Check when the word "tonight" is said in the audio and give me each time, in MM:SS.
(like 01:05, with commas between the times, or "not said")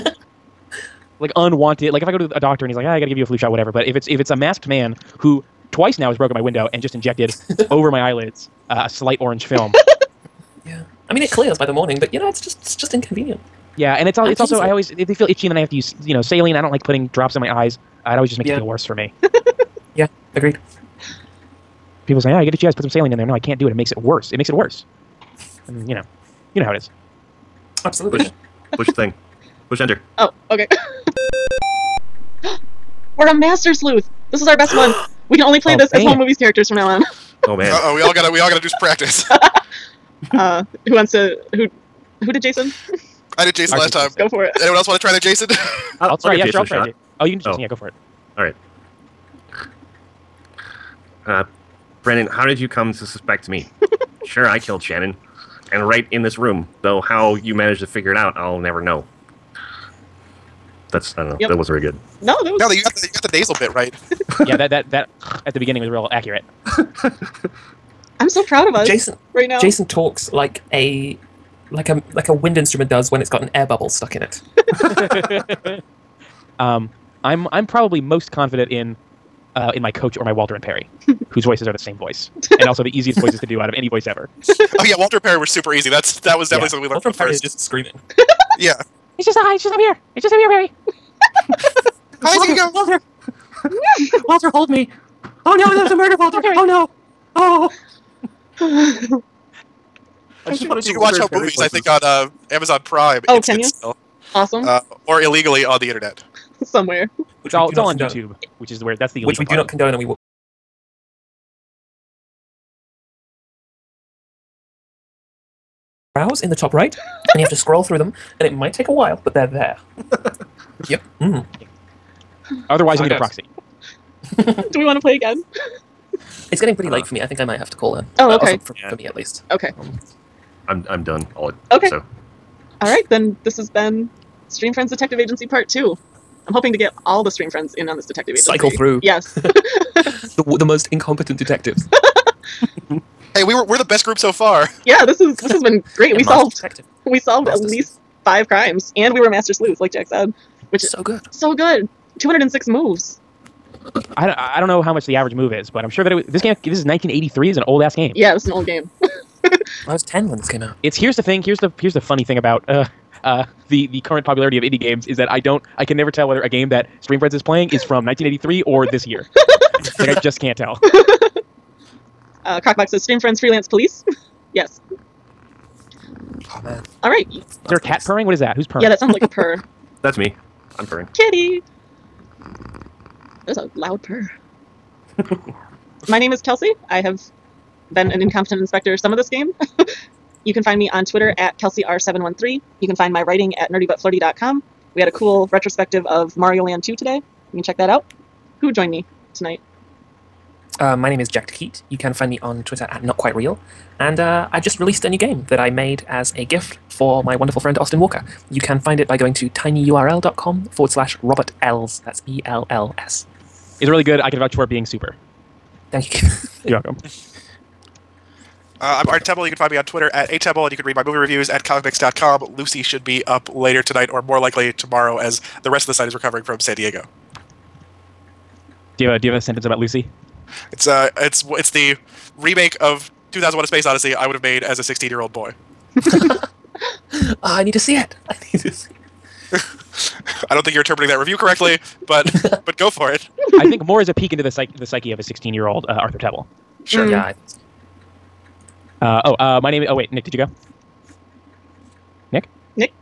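03:19, 03:43.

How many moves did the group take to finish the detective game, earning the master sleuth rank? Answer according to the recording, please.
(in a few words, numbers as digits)
206.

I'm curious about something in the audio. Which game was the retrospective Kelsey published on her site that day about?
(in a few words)
Mario Land 2.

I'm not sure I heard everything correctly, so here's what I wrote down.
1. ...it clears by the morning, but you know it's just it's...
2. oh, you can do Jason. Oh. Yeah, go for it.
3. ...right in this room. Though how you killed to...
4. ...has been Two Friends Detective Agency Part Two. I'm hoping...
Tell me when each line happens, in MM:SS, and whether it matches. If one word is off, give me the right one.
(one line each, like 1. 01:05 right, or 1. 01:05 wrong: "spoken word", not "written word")
1. 00:11 right
2. 00:47 right
3. 00:55 wrong: "managed", not "killed"
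4. 02:13 wrong: "Stream", not "Two".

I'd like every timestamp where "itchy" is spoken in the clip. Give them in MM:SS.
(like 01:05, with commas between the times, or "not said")
00:15, 00:22.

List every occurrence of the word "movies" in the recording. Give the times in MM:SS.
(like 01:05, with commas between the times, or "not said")
00:36, 01:41, 03:41.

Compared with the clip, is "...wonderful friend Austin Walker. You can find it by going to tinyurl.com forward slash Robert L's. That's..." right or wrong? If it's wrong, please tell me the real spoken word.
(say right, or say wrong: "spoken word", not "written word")
right.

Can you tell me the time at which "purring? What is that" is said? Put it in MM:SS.
02:58.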